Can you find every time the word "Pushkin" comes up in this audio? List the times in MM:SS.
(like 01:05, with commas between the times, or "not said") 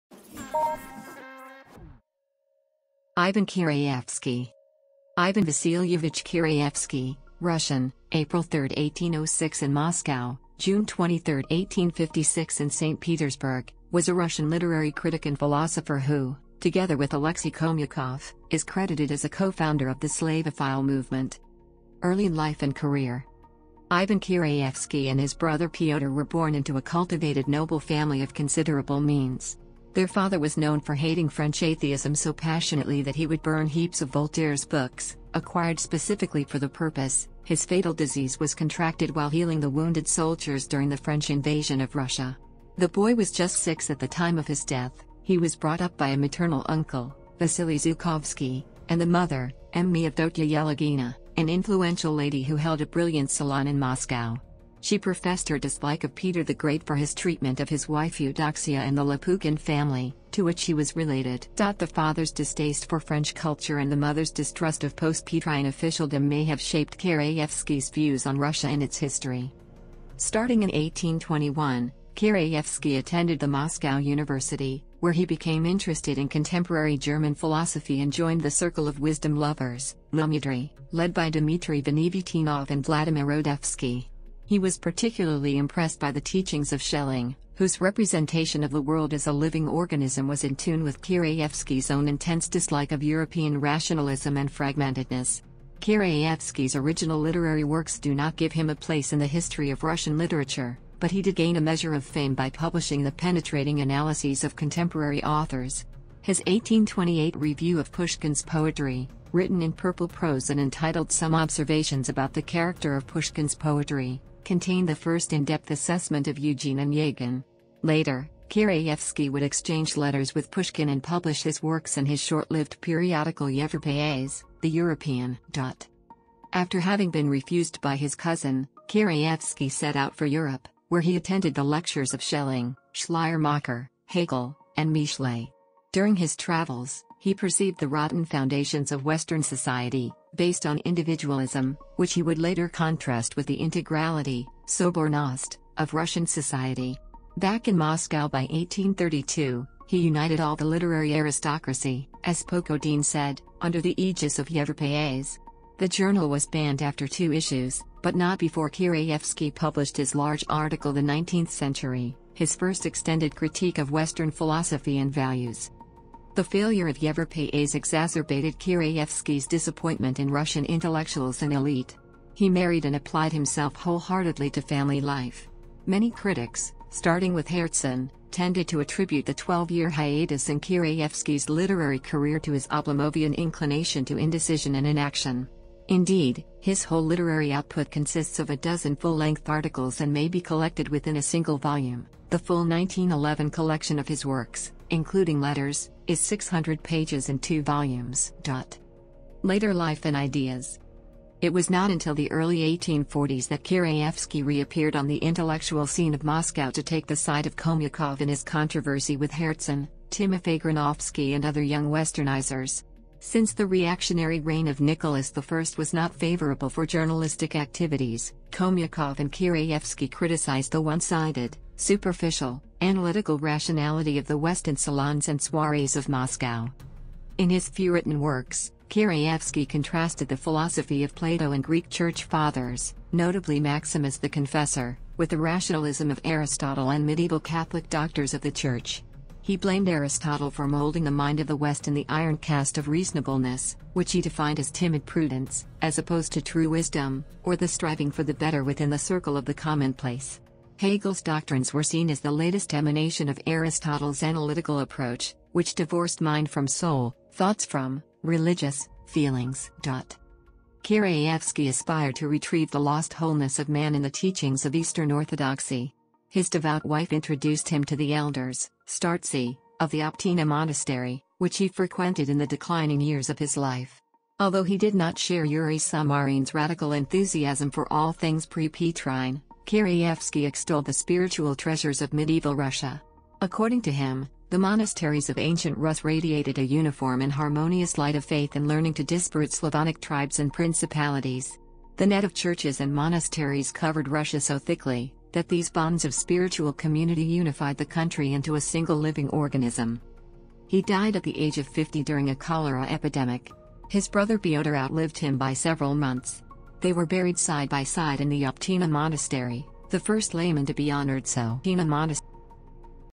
01:47, 01:53, 02:00.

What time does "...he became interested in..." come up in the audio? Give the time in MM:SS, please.
01:15.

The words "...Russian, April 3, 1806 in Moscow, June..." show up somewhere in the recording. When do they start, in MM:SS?
00:07.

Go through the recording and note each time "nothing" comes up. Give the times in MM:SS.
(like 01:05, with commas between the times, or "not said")
not said.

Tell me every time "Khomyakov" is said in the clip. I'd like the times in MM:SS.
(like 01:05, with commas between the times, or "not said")
00:17, 03:27, 03:38.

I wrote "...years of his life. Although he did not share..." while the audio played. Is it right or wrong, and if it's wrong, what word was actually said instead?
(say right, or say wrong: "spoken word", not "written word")
right.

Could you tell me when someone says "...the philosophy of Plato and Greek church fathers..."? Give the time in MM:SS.
03:50.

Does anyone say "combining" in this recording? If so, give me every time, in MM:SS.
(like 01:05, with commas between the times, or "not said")
not said.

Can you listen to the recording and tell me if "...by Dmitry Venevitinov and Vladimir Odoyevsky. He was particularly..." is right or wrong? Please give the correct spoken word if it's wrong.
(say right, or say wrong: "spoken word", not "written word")
right.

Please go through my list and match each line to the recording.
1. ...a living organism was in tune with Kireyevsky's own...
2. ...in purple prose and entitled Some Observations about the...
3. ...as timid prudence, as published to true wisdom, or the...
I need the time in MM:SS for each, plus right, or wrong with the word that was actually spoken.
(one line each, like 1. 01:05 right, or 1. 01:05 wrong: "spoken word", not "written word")
1. 01:29 right
2. 01:49 right
3. 04:04 wrong: "opposed", not "published".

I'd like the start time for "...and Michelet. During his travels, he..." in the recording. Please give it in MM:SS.
02:14.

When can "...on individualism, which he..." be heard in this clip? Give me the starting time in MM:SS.
02:20.